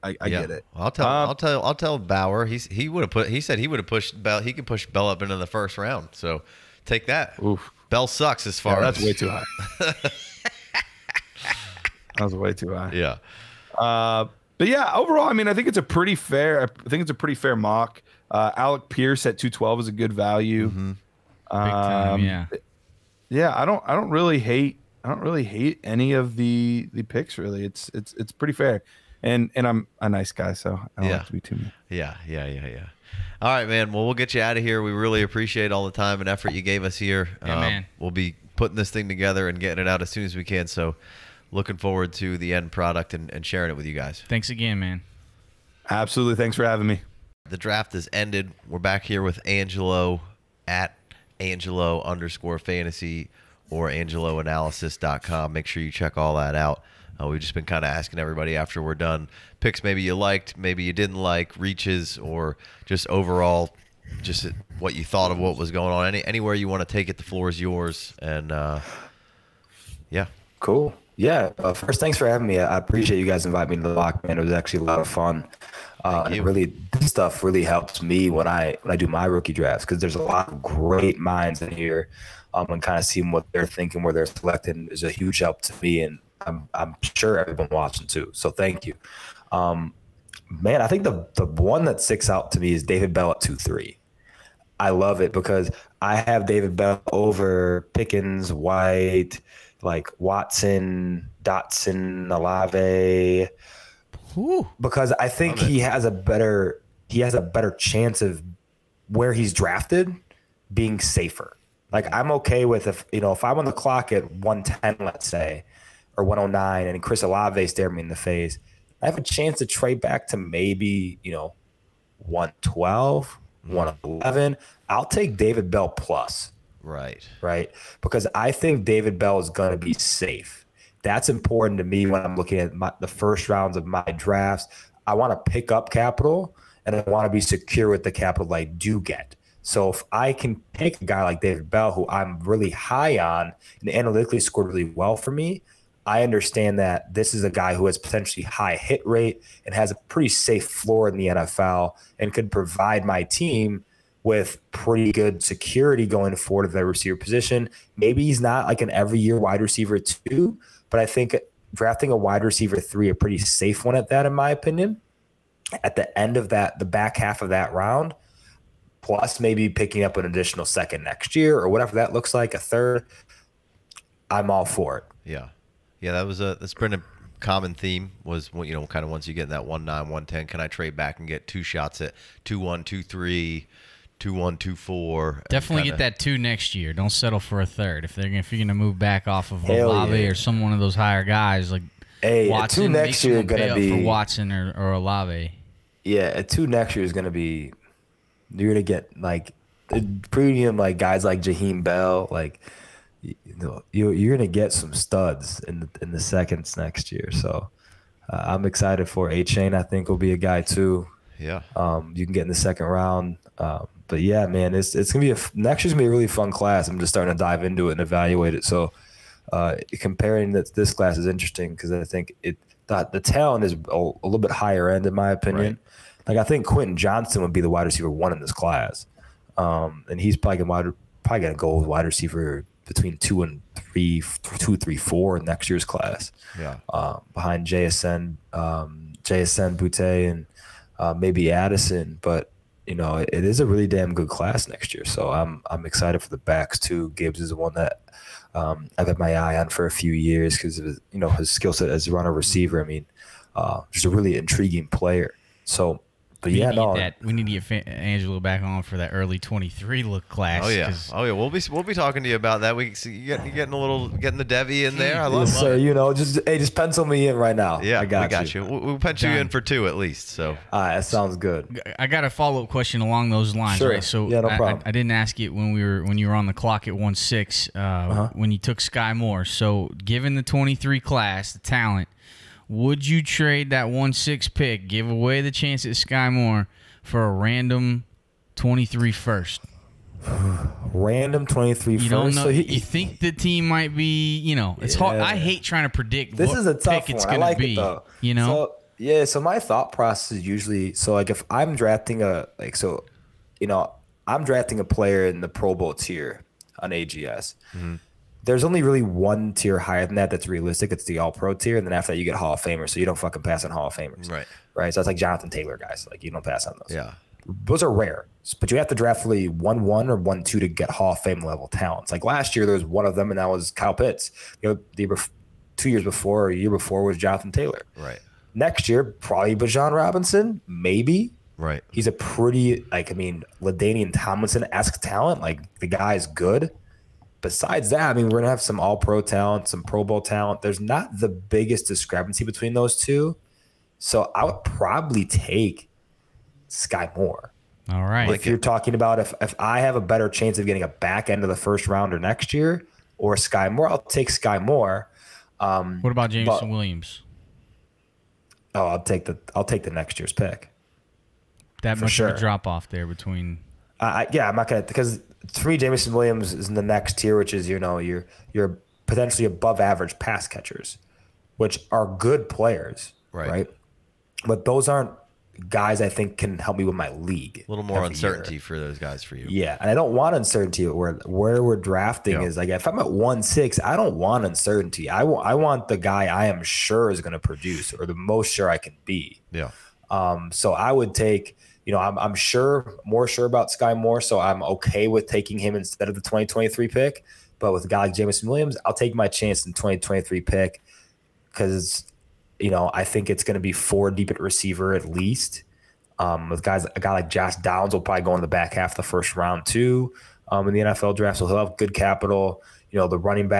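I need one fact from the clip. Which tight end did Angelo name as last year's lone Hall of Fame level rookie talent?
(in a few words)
Kyle Pitts.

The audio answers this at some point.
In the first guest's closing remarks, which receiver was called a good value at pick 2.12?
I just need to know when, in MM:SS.
00:18.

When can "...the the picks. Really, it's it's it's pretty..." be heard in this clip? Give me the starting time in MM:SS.
00:26.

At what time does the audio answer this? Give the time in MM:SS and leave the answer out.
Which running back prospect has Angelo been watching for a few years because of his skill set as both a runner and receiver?
04:07.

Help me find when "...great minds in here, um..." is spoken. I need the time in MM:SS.
01:20.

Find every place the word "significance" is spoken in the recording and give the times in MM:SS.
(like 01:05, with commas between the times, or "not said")
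not said.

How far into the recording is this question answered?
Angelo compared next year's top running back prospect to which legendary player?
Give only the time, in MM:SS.
05:33.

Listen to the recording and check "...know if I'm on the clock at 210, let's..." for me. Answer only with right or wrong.
wrong.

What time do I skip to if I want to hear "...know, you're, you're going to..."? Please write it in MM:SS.
03:23.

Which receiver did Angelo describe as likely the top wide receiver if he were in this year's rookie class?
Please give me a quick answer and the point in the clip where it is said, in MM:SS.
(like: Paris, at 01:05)
Quentin Johnson, at 03:46.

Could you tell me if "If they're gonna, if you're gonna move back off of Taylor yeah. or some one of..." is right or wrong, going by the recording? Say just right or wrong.
wrong.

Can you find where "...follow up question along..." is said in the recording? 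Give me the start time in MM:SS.
04:32.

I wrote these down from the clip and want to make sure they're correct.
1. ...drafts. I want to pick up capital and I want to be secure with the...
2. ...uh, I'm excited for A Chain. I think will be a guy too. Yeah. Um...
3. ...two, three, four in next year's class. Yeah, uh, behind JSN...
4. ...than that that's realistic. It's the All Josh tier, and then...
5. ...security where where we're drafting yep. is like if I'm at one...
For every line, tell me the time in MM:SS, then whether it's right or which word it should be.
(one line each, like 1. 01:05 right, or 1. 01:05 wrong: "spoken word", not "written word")
1. 02:14 right
2. 03:28 right
3. 03:54 right
4. 05:10 wrong: "Pro", not "Josh"
5. 06:20 wrong: "uncertainty", not "security".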